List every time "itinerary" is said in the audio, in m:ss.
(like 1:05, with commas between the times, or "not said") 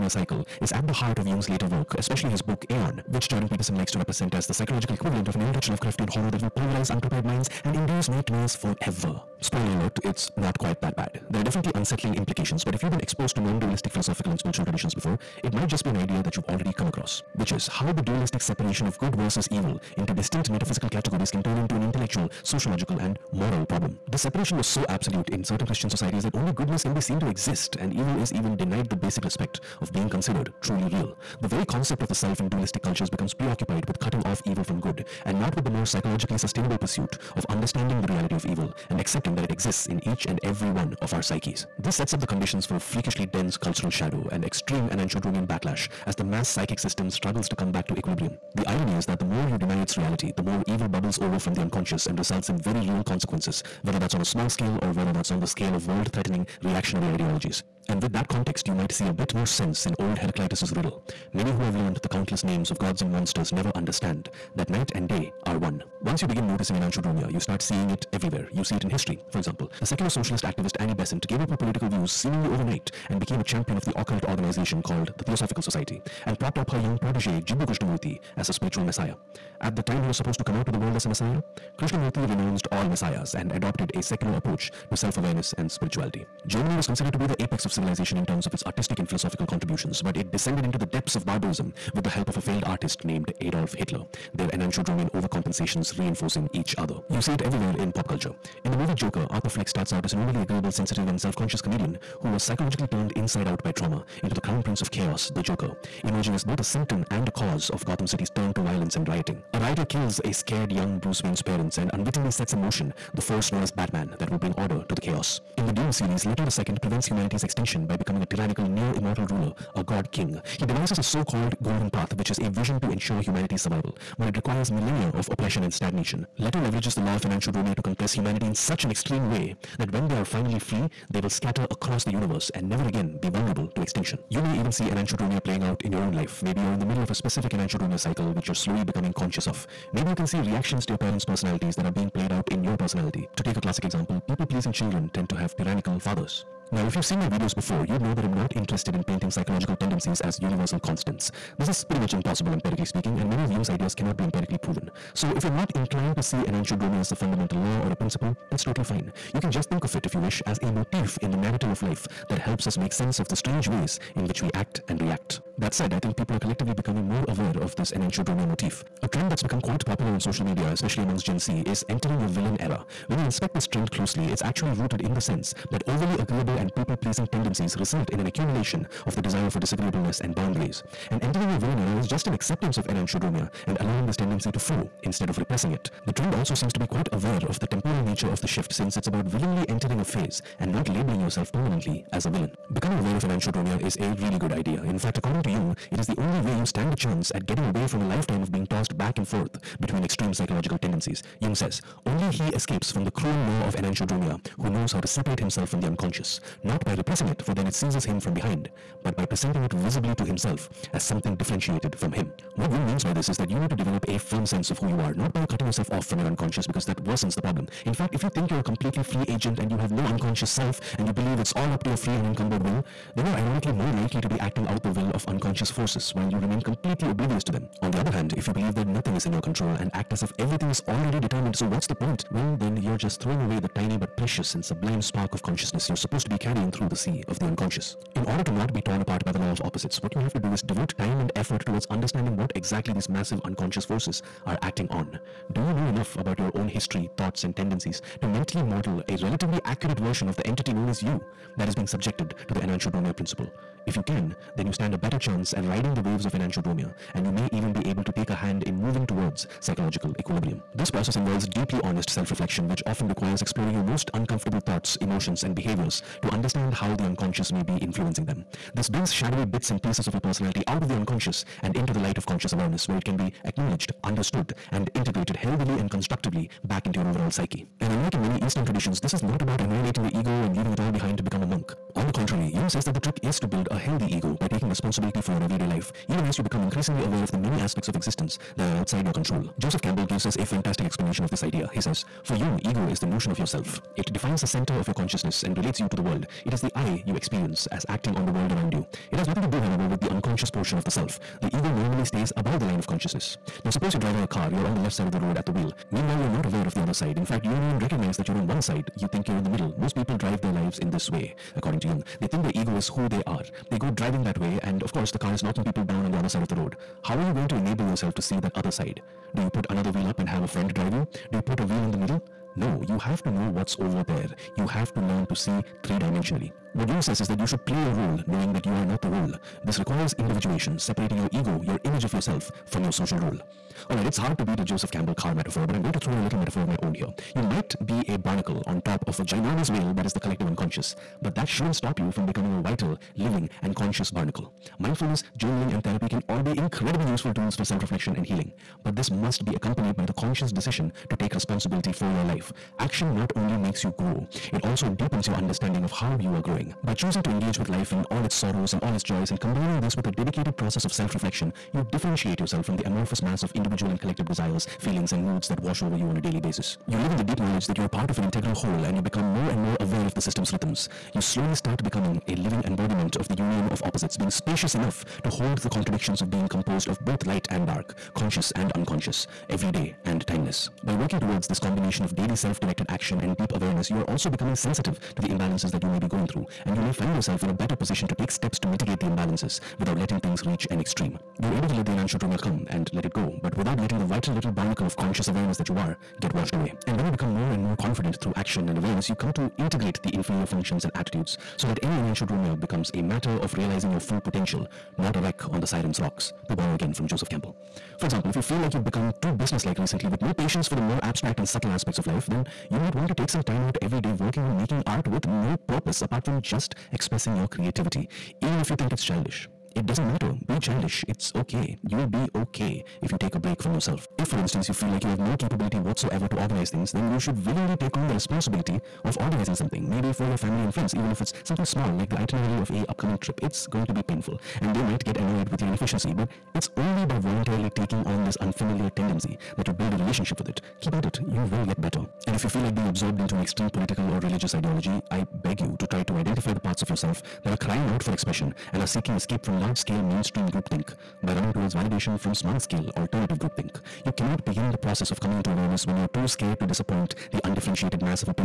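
7:12.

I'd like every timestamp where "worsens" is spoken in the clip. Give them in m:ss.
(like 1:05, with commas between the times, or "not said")
3:37.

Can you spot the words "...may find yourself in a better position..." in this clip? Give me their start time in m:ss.
6:26.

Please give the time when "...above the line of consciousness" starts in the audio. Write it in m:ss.
5:02.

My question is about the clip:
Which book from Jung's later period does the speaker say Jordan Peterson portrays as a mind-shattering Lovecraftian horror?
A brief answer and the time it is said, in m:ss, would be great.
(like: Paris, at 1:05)
Aeon, at 0:02.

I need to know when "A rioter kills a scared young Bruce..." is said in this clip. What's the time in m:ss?
1:49.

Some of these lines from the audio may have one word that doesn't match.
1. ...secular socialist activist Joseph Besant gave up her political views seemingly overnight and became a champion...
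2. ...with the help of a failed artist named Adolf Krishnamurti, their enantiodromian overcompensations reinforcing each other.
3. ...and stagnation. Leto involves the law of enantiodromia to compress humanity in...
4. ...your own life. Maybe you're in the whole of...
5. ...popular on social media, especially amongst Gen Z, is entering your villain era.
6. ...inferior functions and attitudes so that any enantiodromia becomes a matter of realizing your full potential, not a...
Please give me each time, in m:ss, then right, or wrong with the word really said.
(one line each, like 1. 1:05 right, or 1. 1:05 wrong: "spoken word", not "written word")
1. 1:09 wrong: "Annie", not "Joseph"
2. 1:31 wrong: "Hitler", not "Krishnamurti"
3. 2:05 wrong: "leverages", not "involves"
4. 2:15 wrong: "middle", not "whole"
5. 2:49 right
6. 6:40 right.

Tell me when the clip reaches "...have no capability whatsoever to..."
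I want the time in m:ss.
7:05.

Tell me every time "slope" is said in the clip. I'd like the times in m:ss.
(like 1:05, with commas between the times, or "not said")
not said.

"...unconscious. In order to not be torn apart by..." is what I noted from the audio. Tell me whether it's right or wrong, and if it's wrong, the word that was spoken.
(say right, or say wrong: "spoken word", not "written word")
right.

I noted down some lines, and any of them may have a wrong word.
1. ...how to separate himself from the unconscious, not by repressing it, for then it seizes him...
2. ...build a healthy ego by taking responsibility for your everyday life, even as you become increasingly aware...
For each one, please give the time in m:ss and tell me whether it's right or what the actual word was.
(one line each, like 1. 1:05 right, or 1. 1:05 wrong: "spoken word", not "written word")
1. 3:24 right
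2. 4:43 right.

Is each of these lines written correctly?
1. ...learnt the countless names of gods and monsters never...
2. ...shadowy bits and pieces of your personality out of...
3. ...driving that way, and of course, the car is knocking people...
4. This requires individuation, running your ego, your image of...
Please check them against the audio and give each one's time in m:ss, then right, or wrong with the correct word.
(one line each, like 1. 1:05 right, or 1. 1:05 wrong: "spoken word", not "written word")
1. 1:01 right
2. 4:29 right
3. 5:13 right
4. 5:29 wrong: "separating", not "running".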